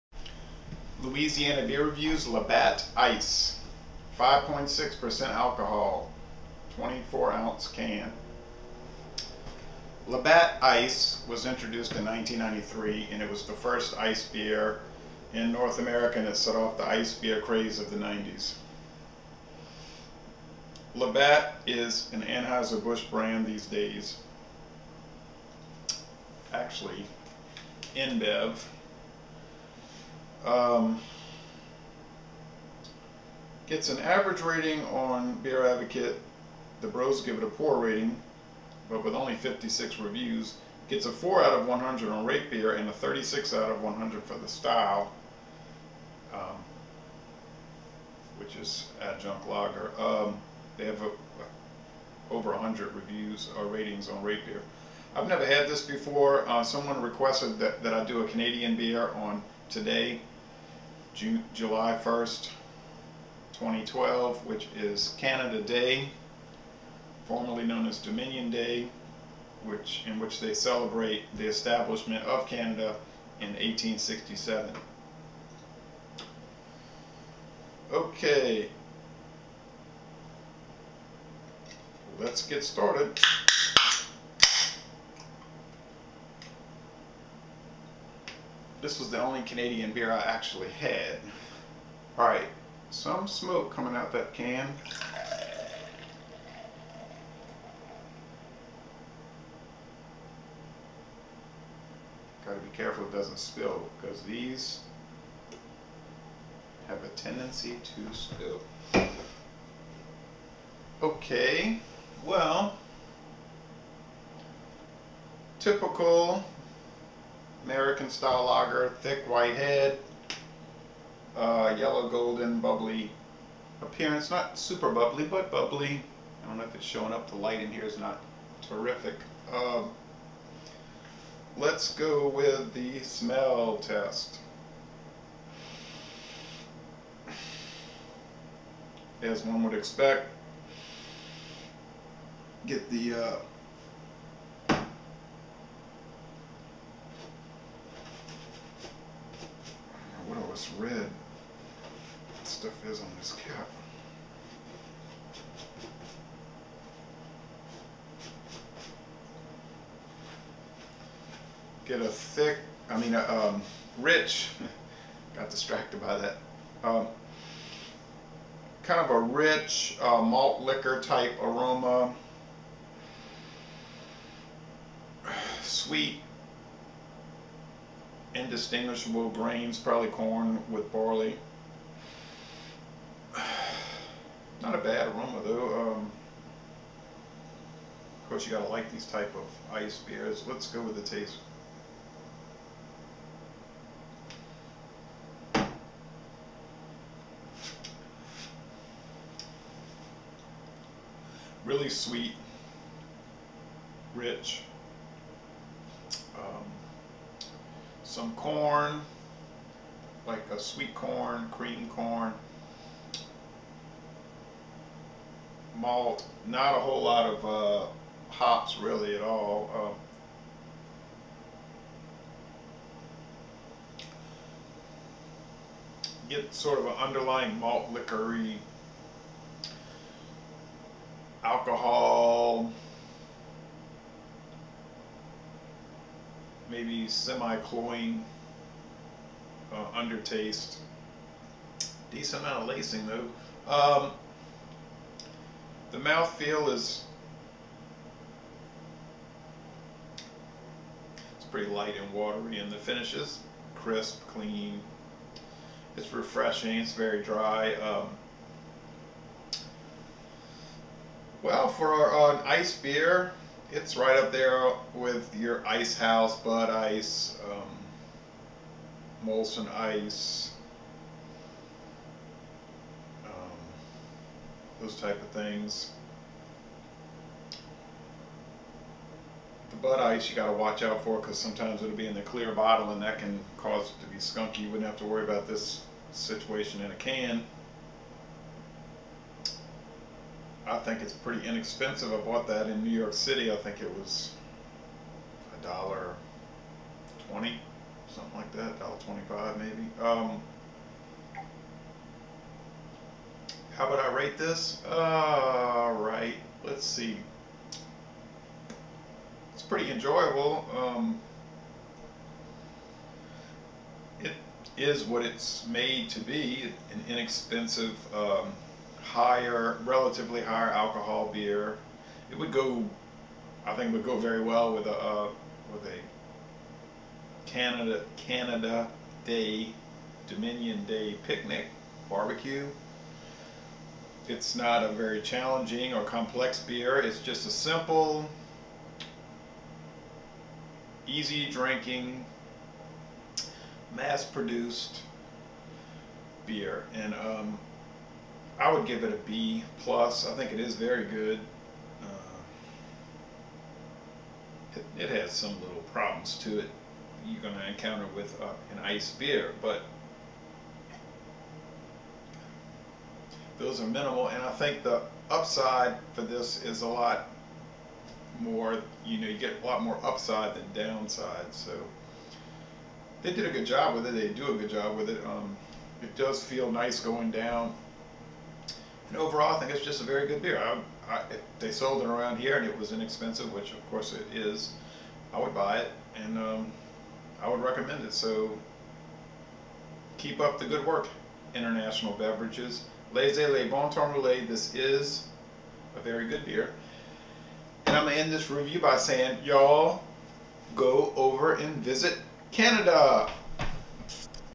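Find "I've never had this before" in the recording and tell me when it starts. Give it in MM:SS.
00:55.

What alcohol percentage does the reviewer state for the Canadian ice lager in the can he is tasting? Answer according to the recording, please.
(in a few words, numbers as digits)
5.6%.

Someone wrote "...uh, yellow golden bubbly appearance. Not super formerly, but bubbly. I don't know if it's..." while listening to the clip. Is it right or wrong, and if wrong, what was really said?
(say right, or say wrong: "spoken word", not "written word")
wrong: "bubbly", not "formerly".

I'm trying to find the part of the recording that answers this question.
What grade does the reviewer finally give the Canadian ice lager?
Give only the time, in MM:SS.
05:49.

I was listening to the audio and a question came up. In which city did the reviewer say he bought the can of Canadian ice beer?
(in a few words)
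New York City.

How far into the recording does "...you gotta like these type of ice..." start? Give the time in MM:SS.
03:08.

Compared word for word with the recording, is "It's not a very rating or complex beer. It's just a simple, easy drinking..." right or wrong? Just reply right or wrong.
wrong.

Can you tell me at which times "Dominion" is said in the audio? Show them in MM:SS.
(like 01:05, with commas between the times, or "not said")
01:07, 05:30.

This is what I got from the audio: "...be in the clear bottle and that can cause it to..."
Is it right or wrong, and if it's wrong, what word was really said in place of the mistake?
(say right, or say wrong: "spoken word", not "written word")
right.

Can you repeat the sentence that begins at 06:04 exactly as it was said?
And I think the upside for this is a lot more.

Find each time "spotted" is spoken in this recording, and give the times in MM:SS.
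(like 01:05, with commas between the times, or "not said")
not said.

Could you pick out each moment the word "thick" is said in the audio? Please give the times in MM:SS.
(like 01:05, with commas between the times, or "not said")
01:59, 02:42.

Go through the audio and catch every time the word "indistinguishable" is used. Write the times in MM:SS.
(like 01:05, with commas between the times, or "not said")
02:58.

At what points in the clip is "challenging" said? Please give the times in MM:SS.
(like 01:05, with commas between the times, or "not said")
05:35.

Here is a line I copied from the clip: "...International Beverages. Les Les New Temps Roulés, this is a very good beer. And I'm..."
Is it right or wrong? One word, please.
wrong.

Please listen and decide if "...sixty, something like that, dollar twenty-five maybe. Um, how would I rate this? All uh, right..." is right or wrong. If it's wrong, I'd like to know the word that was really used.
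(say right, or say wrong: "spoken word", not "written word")
wrong: "twenty", not "sixty".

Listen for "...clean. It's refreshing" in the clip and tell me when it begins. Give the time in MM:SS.
04:14.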